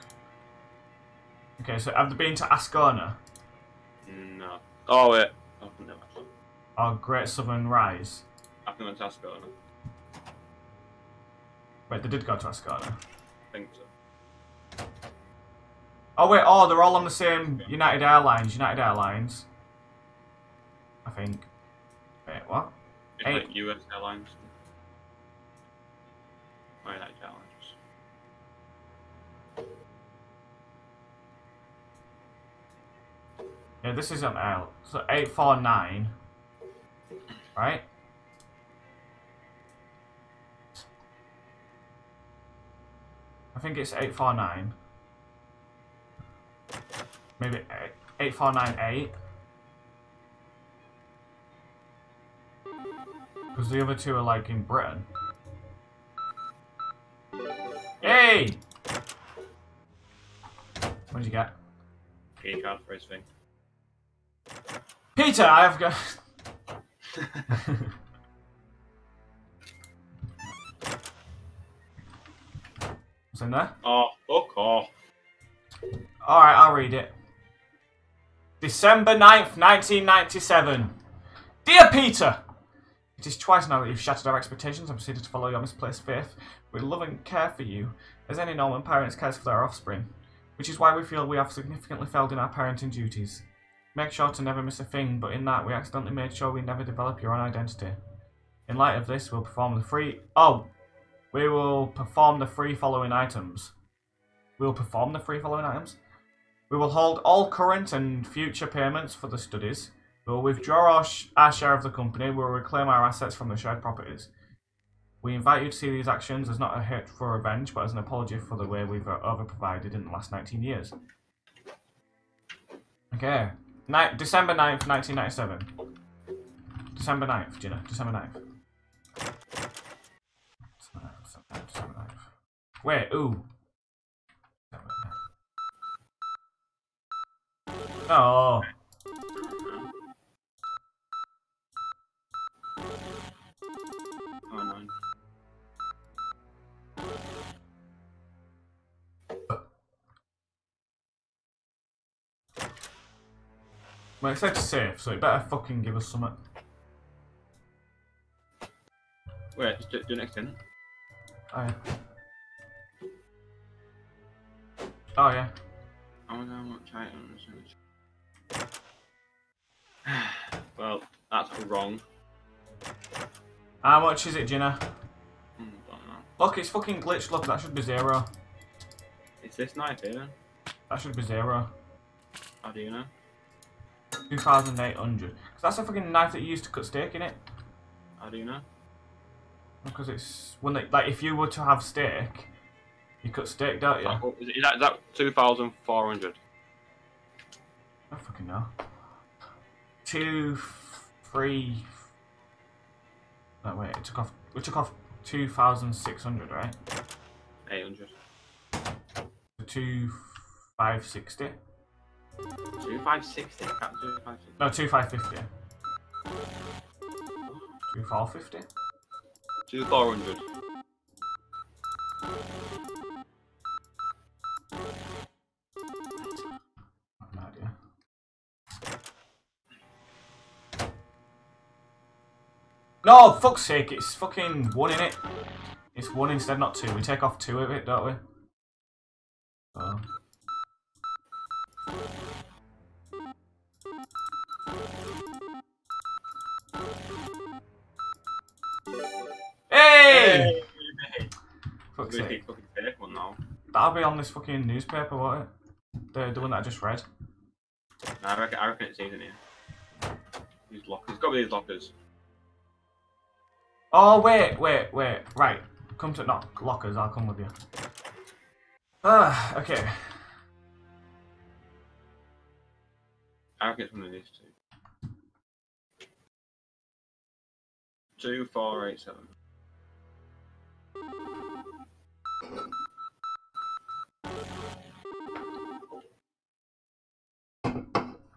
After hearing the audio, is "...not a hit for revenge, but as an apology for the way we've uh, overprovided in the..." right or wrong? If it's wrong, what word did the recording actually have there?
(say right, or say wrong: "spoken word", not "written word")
right.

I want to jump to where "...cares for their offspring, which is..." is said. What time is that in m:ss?
1:29.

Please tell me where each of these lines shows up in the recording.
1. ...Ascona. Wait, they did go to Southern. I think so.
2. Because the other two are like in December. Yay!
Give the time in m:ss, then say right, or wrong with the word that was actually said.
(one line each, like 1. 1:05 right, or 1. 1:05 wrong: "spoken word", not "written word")
1. 0:09 wrong: "Ascada", not "Southern"
2. 0:53 wrong: "Britain", not "December".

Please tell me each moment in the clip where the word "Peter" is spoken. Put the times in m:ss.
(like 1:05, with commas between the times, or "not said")
1:05, 1:21.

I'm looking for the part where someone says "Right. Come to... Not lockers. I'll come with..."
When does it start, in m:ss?
4:25.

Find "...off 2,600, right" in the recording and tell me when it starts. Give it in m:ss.
3:24.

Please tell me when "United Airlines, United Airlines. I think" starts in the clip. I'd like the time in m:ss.
0:17.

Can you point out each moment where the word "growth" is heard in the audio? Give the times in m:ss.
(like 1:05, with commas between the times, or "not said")
not said.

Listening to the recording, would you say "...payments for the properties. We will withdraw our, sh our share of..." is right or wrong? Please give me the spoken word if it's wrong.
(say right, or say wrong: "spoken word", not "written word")
wrong: "studies", not "properties".